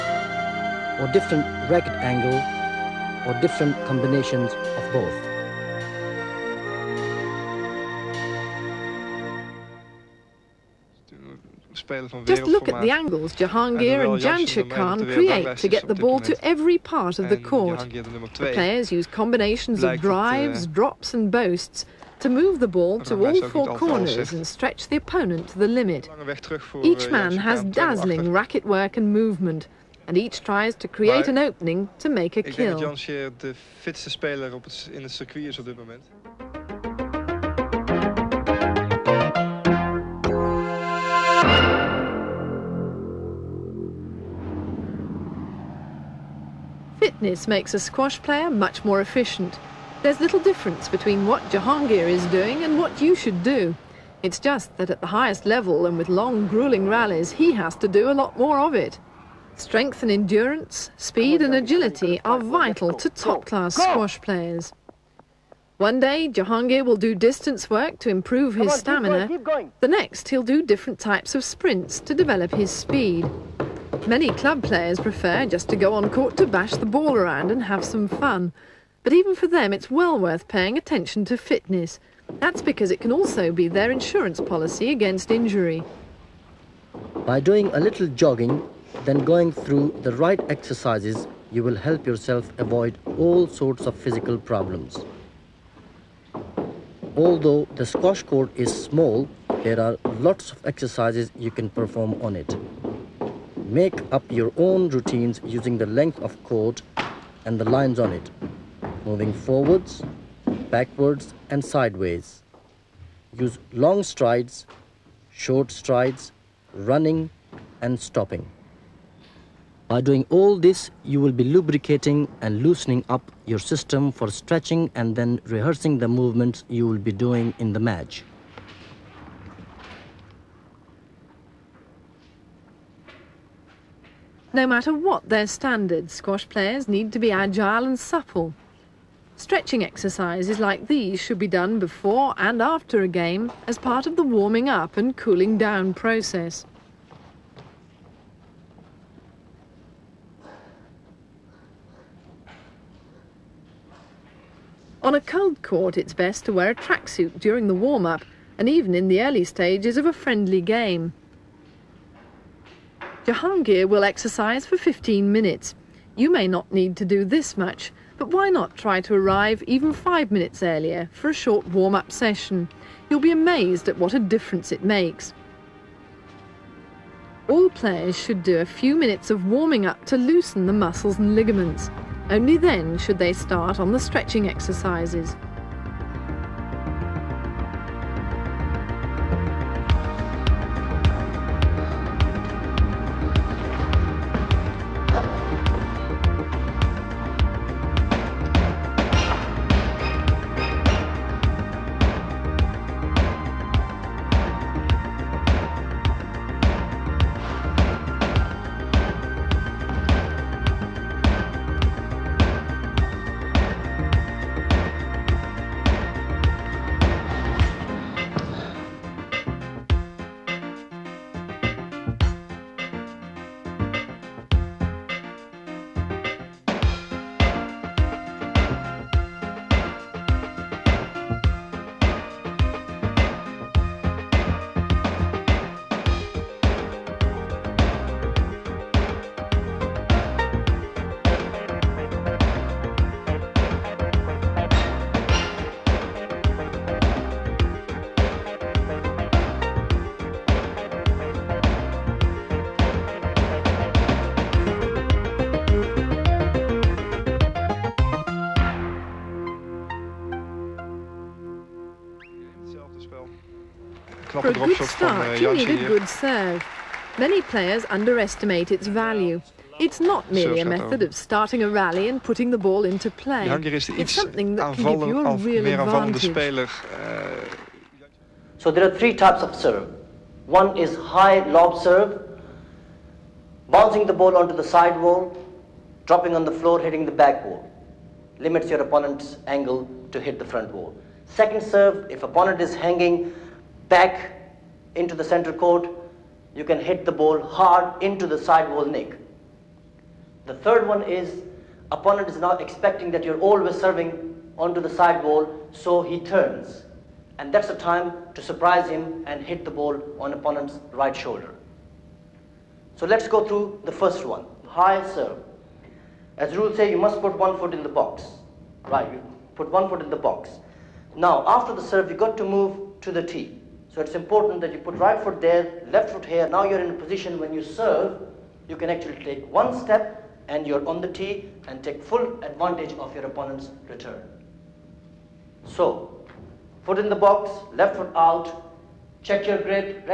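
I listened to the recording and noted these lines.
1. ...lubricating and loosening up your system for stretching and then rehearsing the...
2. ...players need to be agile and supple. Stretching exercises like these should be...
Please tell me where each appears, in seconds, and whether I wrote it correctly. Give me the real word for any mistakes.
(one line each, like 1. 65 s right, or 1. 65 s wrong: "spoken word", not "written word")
1. 121 s right
2. 136 s right.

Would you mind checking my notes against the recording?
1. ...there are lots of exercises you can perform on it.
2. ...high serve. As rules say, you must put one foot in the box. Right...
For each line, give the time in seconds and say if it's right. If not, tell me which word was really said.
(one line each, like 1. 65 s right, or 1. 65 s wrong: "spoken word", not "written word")
1. 99 s right
2. 314 s right.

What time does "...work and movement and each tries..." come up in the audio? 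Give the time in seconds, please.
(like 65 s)
28 s.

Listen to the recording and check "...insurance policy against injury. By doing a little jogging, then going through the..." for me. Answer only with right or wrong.
right.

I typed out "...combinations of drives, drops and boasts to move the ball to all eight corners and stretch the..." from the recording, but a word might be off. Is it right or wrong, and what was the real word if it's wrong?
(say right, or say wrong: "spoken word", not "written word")
wrong: "four", not "eight".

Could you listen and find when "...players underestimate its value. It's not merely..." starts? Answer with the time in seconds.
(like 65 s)
267 s.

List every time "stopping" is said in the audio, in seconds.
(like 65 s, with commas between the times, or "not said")
118 s.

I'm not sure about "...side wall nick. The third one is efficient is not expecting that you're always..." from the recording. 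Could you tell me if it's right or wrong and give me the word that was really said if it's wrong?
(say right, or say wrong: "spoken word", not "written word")
wrong: "opponent", not "efficient".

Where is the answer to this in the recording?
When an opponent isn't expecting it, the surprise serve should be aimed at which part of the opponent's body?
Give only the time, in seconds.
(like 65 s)
310 s.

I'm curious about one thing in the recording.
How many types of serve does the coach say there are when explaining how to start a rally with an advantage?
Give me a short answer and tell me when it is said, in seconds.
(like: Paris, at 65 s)
3, at 278 s.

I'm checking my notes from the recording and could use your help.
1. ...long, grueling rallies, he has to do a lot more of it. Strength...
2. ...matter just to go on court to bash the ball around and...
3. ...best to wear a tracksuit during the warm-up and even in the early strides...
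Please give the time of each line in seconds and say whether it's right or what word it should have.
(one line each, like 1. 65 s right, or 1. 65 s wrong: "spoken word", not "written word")
1. 56 s right
2. 74 s wrong: "prefer", not "matter"
3. 156 s wrong: "stages", not "strides".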